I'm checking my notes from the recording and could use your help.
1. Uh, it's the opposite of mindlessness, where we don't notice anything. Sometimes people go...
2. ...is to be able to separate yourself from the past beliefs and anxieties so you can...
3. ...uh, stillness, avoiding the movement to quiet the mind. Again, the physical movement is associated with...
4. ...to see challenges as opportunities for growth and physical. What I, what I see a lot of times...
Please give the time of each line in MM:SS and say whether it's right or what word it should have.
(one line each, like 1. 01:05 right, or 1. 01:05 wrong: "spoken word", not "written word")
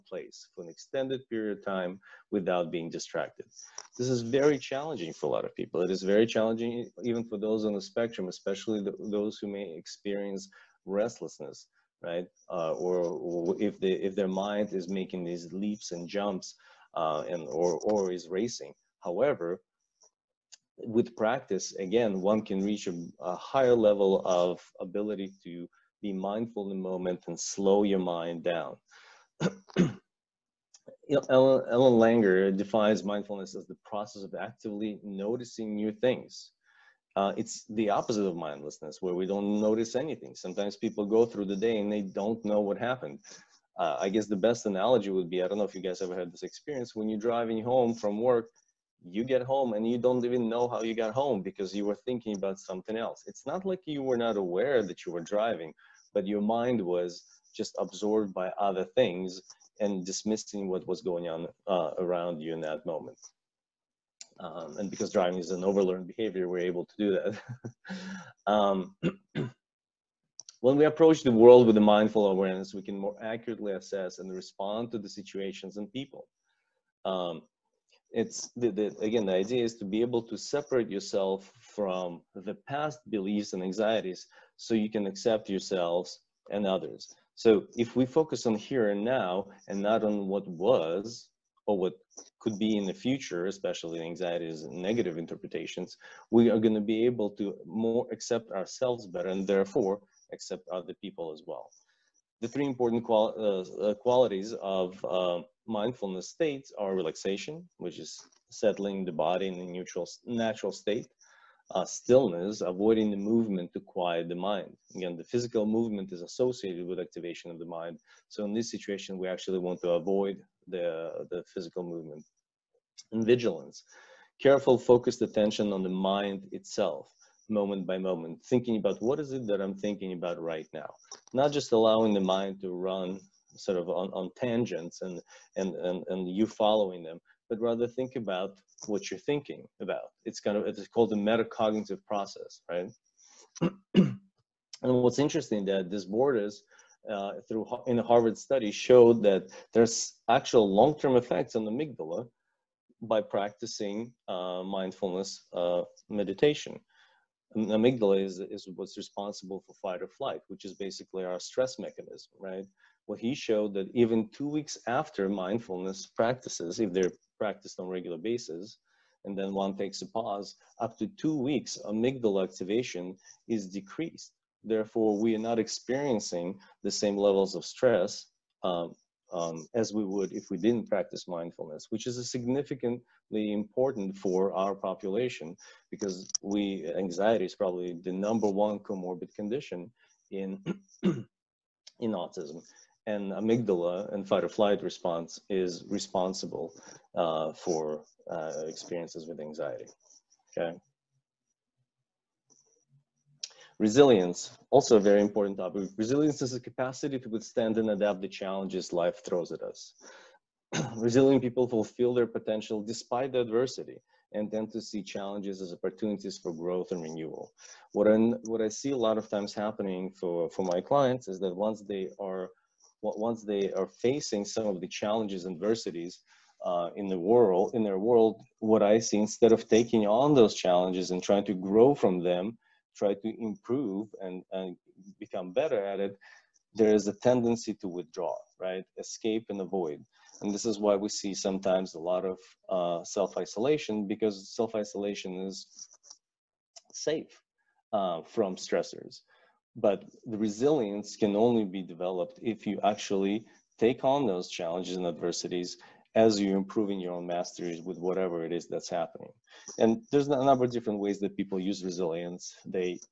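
1. 00:37 right
2. 01:19 right
3. 01:51 right
4. 03:34 wrong: "renewal", not "physical".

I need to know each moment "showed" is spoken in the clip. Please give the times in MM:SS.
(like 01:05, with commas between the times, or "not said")
02:28, 02:43.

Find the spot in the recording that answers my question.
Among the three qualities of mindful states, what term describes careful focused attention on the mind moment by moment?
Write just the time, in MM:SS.
02:03.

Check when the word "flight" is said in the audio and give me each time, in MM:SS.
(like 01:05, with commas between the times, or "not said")
02:40, 03:14.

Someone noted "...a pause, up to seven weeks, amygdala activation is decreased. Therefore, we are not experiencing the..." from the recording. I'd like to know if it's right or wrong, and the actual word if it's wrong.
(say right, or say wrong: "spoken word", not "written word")
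wrong: "two", not "seven".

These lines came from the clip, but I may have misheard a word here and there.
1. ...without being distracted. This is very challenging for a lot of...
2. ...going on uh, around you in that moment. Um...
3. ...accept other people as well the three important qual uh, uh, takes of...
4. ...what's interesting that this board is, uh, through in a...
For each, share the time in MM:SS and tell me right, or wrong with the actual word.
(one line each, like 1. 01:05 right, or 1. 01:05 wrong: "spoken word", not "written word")
1. 00:02 right
2. 01:01 right
3. 01:40 wrong: "qualities", not "takes"
4. 02:24 right.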